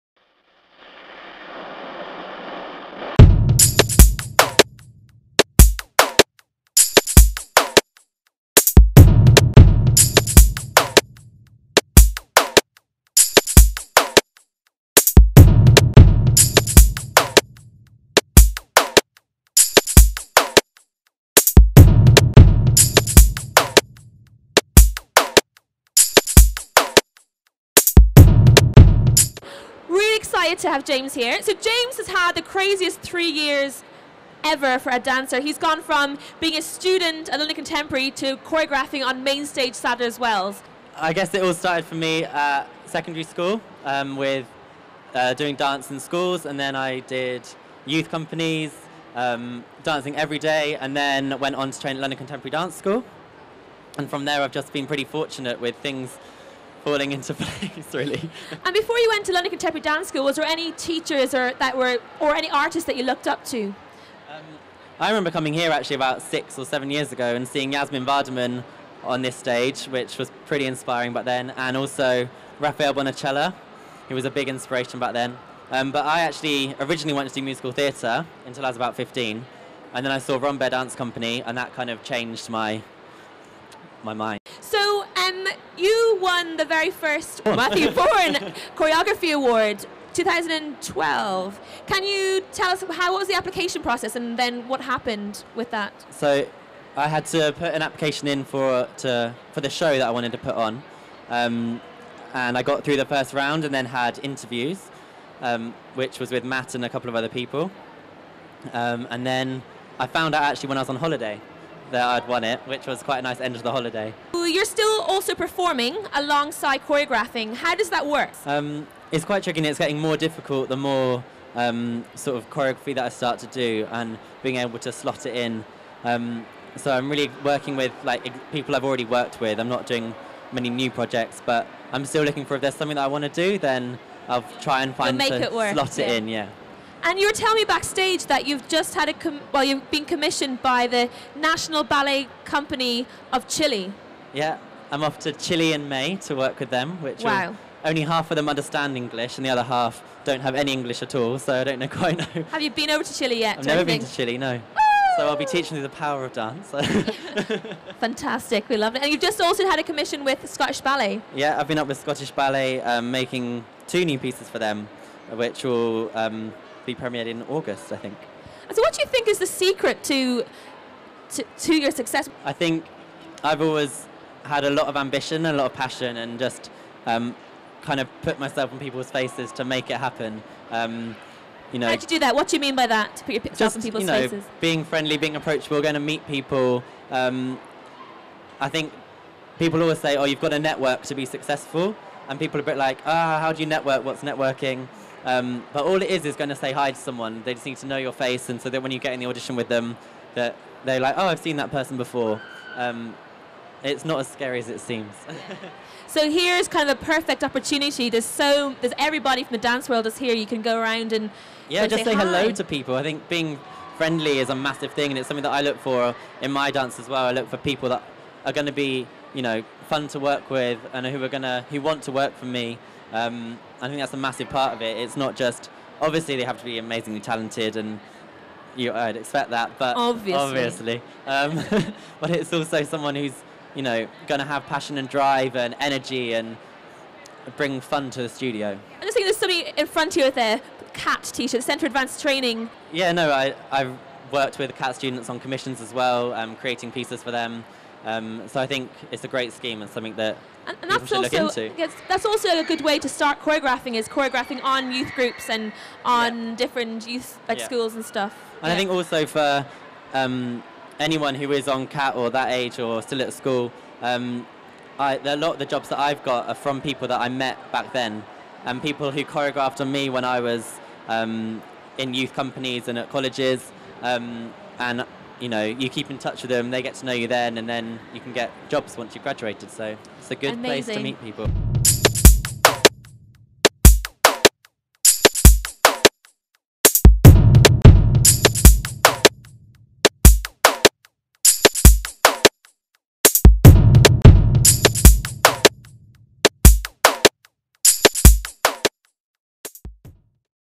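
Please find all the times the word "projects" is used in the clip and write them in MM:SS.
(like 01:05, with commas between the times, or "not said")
02:10.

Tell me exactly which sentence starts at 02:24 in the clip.
Yeah, I'm off to Chile in May to work with them, which wow.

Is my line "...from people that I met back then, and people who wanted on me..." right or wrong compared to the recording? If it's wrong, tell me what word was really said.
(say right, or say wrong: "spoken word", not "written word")
wrong: "choreographed", not "wanted".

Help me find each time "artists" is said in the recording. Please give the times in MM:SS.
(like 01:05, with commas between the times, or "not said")
01:02.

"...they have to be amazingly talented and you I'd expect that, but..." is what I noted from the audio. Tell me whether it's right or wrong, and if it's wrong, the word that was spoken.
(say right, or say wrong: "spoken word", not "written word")
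right.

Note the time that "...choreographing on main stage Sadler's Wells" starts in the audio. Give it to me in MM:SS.
00:38.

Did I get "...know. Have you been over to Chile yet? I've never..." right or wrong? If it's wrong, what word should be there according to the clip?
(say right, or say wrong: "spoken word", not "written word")
right.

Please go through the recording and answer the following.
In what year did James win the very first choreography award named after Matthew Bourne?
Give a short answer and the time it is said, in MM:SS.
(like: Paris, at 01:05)
2012, at 01:30.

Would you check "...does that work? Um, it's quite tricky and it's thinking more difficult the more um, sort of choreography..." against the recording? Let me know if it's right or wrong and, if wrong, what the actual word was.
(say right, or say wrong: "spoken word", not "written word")
wrong: "getting", not "thinking".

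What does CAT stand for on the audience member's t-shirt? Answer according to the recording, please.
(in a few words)
Centre Advanced Training.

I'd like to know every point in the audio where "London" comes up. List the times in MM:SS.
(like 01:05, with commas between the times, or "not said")
00:37, 00:52, 00:59.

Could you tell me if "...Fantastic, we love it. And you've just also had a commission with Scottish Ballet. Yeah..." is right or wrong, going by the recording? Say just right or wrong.
right.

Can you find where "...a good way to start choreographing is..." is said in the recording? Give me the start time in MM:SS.
04:12.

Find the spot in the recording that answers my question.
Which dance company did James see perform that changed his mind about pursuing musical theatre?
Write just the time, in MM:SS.
01:20.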